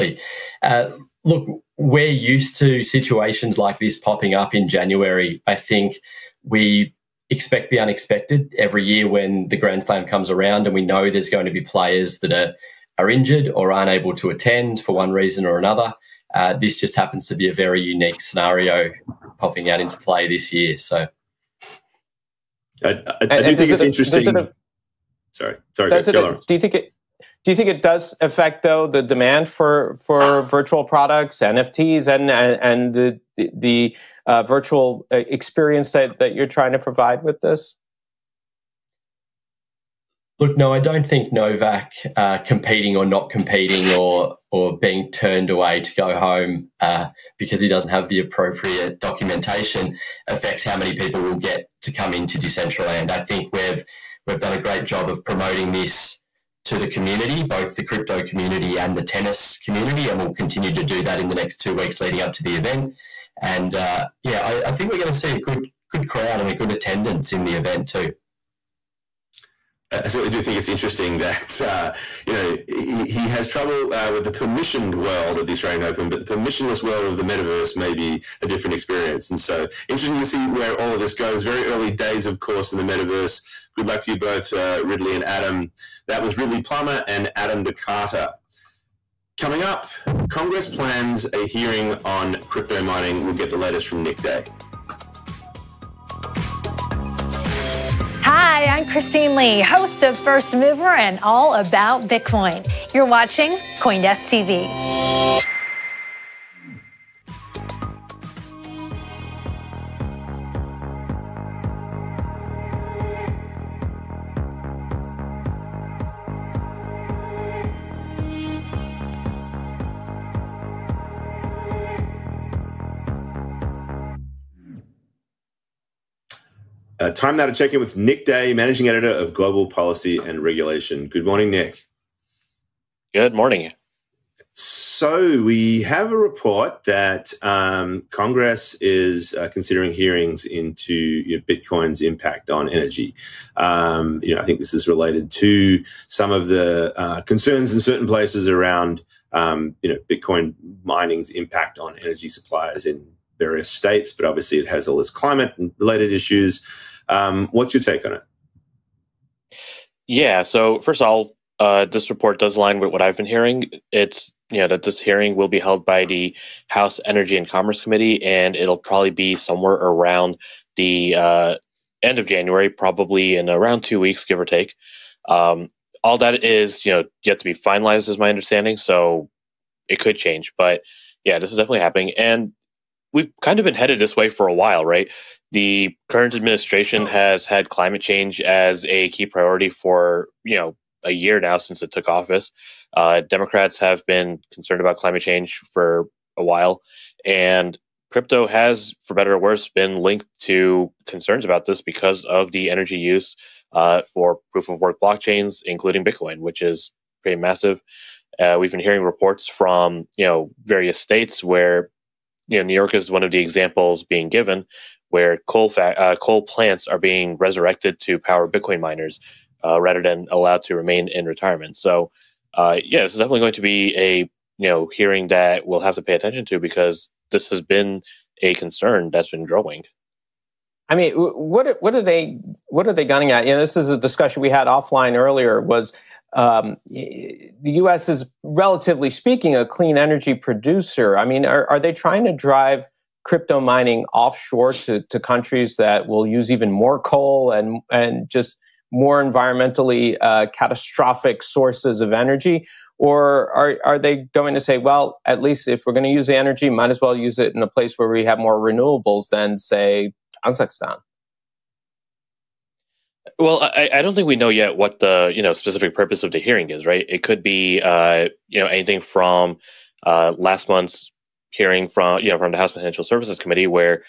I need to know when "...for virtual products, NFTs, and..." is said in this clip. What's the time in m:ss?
0:30.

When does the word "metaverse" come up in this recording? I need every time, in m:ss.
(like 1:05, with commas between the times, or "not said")
1:17, 1:22.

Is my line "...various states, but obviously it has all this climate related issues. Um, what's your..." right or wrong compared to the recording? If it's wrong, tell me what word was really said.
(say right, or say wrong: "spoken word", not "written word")
right.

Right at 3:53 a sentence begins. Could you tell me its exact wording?
You know, this is a discussion we had offline earlier.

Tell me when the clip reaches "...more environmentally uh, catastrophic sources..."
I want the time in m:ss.
4:08.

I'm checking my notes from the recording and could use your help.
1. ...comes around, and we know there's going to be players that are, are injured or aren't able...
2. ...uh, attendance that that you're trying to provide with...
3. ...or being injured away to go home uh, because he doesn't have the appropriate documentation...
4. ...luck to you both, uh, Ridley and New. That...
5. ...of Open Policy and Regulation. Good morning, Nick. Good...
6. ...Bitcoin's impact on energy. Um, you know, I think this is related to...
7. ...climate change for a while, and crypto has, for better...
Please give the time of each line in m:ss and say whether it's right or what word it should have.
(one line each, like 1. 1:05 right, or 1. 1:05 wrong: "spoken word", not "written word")
1. 0:10 right
2. 0:35 wrong: "experience", not "attendance"
3. 0:44 wrong: "turned", not "injured"
4. 1:23 wrong: "Adam", not "New"
5. 2:09 wrong: "Global", not "Open"
6. 2:21 right
7. 3:14 right.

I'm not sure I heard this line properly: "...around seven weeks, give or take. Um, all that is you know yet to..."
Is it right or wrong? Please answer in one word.
wrong.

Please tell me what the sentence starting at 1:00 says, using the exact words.
And we'll continue to do that in the next two weeks leading up to the event.